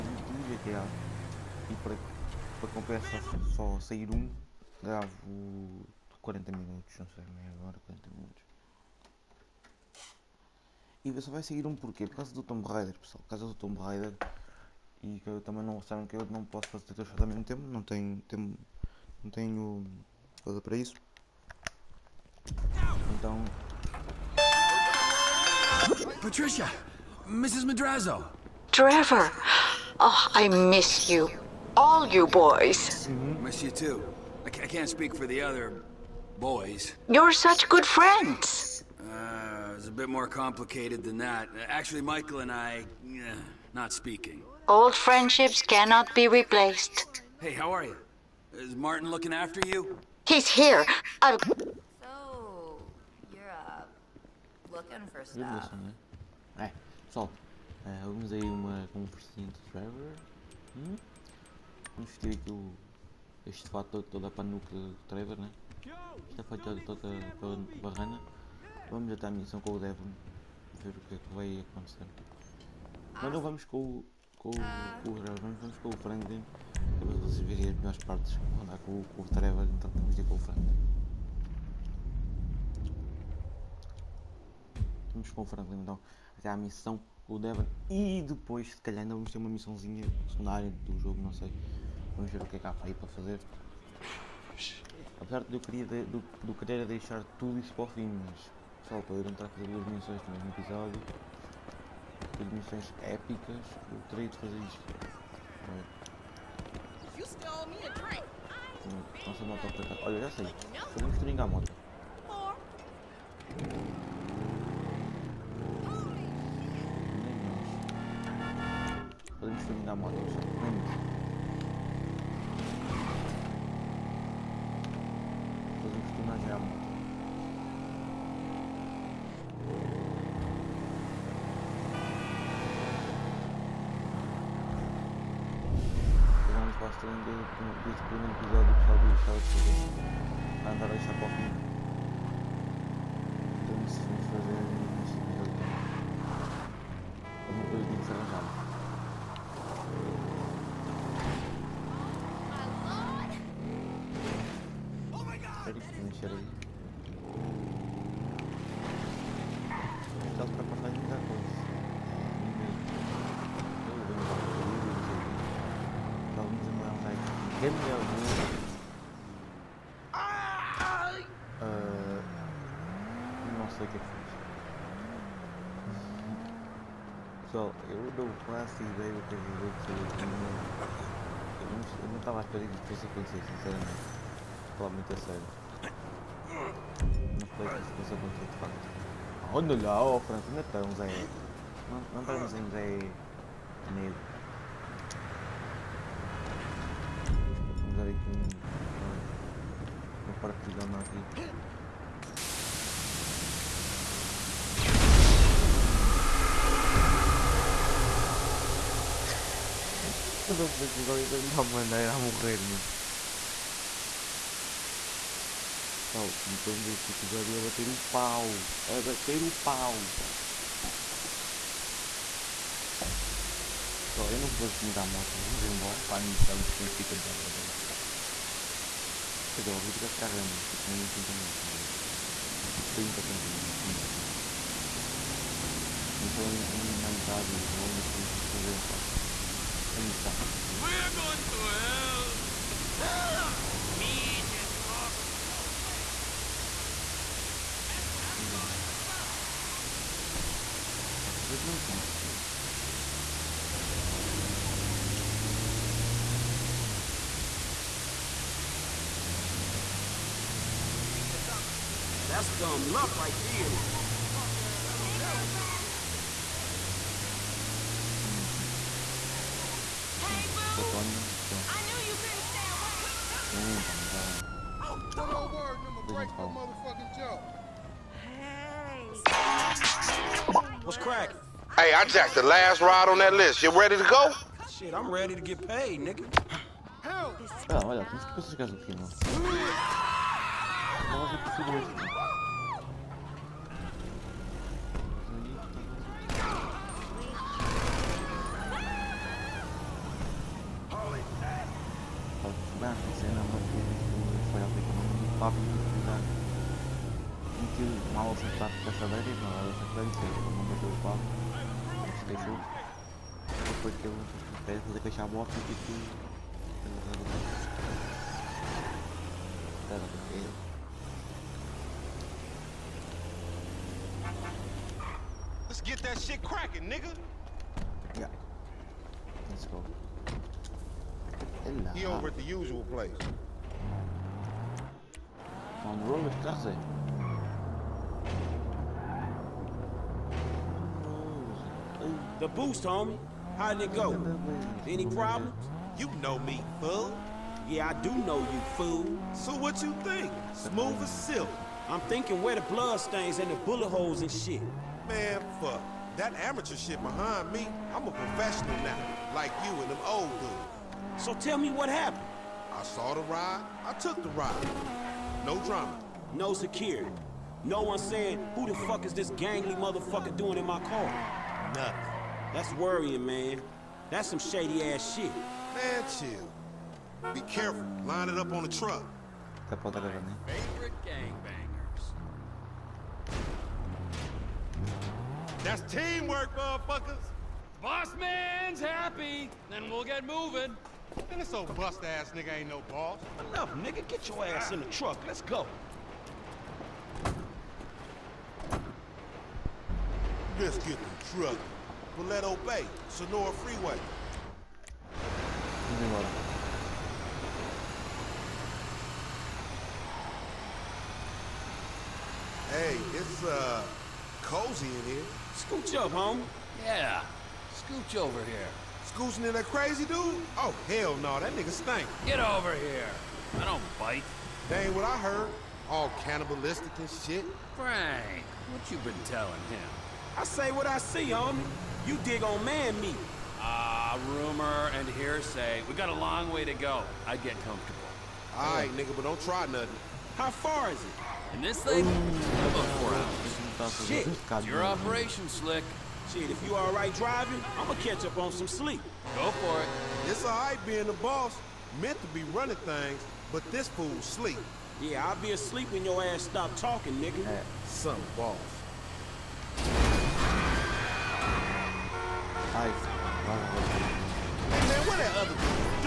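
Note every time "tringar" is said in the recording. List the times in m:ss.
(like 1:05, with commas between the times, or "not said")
1:51, 1:59.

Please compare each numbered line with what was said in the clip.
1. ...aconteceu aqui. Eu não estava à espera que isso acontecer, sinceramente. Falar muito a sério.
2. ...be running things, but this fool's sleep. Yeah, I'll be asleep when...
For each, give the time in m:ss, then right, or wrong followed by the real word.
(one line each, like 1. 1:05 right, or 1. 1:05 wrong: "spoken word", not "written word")
1. 2:59 right
2. 7:32 right.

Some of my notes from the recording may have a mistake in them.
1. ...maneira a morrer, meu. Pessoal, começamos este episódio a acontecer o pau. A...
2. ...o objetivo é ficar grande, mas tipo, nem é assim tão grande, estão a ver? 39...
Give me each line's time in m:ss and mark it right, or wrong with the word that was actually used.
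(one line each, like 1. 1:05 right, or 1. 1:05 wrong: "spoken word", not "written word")
1. 3:31 wrong: "bater", not "acontecer"
2. 3:49 wrong: "30", not "39".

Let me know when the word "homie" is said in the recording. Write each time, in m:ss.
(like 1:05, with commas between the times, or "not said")
5:42, 7:11.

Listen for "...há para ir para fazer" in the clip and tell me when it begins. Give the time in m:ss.
1:32.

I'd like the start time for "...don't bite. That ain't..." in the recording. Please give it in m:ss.
7:03.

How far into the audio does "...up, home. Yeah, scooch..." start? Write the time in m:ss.
6:55.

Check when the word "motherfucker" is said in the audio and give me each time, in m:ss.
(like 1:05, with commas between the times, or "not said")
6:09, 6:26.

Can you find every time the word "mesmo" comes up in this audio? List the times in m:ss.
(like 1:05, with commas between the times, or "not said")
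0:17, 1:40.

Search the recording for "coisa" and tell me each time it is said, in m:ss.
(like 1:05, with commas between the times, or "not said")
0:20, 2:27.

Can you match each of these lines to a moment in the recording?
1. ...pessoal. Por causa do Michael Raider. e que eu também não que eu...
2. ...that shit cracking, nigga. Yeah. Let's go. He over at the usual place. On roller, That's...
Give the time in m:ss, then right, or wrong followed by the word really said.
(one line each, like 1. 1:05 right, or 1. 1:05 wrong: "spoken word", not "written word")
1. 0:12 wrong: "Tomb", not "Michael"
2. 5:26 right.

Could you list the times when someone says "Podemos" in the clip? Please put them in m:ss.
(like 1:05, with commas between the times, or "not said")
1:50, 1:59.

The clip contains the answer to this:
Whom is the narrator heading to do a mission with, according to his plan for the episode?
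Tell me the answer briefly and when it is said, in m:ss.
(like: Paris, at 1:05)
Devin, at 1:09.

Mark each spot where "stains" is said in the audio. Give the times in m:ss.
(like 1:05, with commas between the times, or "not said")
5:53.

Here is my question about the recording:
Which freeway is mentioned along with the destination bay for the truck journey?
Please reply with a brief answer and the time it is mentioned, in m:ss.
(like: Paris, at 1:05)
Senora Freeway, at 6:43.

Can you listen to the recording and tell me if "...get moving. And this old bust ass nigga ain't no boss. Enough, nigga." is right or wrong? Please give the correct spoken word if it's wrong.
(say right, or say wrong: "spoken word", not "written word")
right.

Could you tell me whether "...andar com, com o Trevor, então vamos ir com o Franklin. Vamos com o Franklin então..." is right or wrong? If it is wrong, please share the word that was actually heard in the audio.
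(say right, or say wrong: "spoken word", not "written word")
right.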